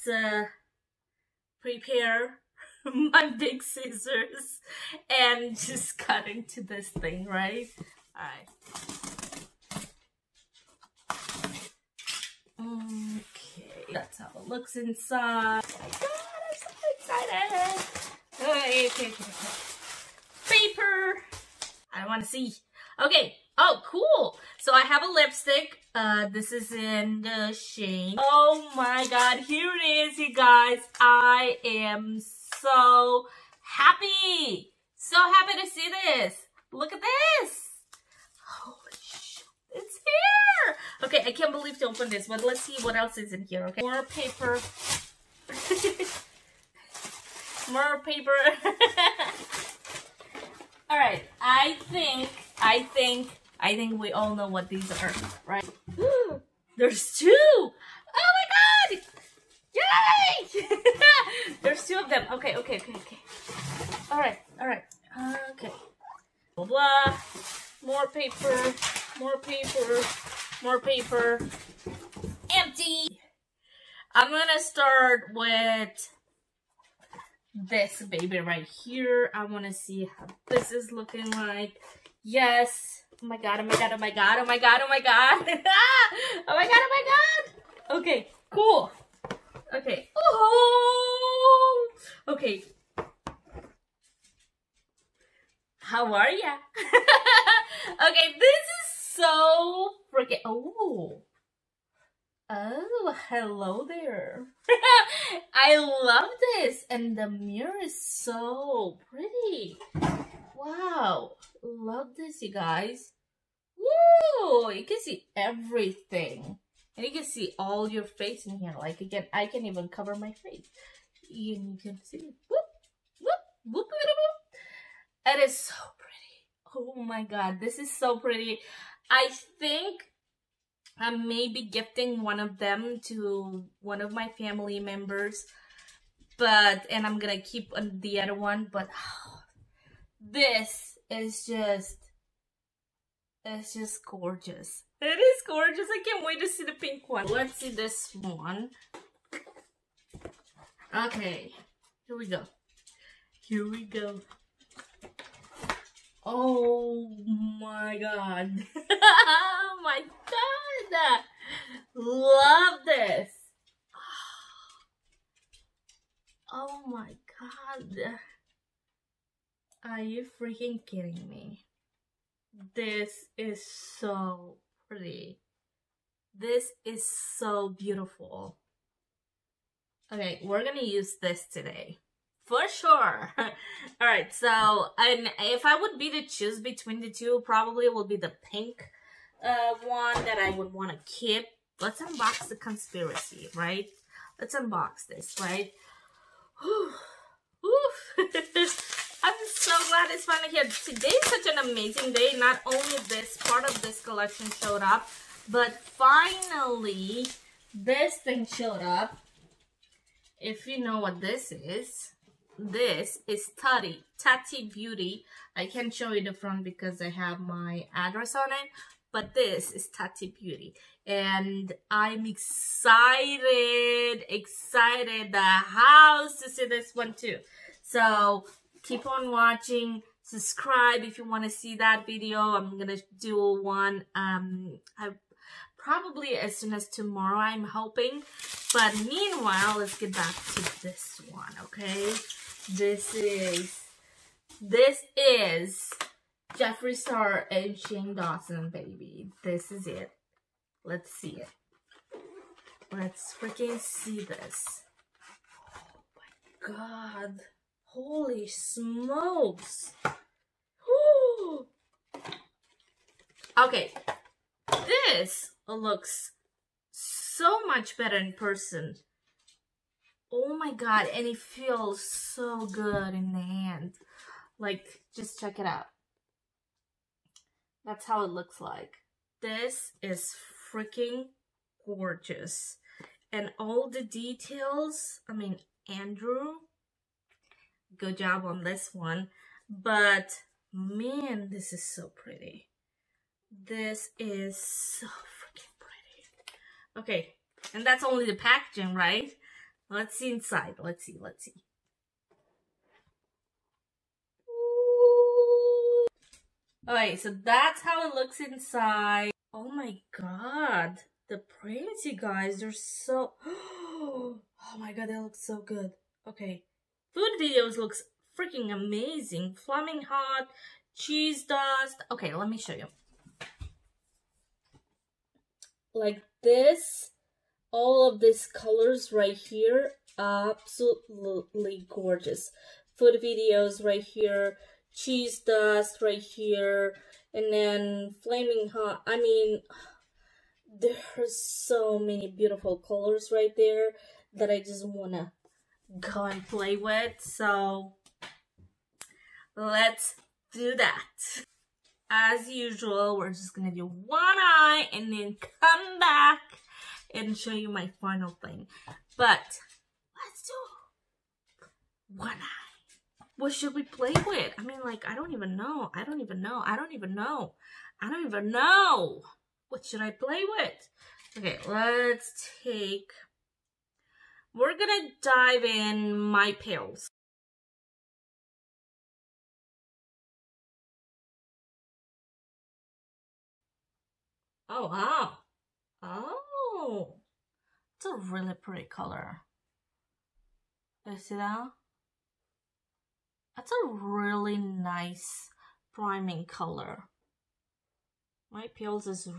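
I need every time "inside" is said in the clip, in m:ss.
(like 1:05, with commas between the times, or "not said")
0:14, 5:00, 5:08.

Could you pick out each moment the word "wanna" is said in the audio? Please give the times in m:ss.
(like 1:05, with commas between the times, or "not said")
1:19, 5:44.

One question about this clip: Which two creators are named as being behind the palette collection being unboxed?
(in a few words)
Jeffree Star and Shane Dawson.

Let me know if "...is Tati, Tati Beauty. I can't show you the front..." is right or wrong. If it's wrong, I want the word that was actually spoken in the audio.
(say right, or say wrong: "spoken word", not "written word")
right.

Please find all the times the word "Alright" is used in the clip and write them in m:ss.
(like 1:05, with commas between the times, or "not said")
3:03, 5:06.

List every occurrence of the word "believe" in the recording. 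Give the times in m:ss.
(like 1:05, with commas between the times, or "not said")
0:41.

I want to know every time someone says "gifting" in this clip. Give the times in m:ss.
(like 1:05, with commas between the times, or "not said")
2:11.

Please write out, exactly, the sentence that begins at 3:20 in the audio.
Today is such an amazing day.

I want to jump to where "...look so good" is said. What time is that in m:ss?
5:15.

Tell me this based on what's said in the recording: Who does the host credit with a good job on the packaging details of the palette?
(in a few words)
Andrew.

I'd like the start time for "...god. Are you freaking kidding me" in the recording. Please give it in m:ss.
2:47.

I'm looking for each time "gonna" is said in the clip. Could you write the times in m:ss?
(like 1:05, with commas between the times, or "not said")
1:14, 2:17, 3:00, 5:53, 6:14.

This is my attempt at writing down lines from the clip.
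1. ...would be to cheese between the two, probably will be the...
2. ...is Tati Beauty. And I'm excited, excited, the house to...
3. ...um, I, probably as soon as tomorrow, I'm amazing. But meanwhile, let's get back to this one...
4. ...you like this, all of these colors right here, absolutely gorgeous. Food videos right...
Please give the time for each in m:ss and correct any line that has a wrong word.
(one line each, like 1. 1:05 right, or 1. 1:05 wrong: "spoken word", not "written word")
1. 3:05 wrong: "choose", not "cheese"
2. 3:39 right
3. 3:54 wrong: "hoping", not "amazing"
4. 5:22 right.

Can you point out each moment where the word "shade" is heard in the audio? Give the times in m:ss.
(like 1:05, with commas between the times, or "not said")
0:27.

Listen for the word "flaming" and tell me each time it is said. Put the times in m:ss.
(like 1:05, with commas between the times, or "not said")
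5:19, 5:38.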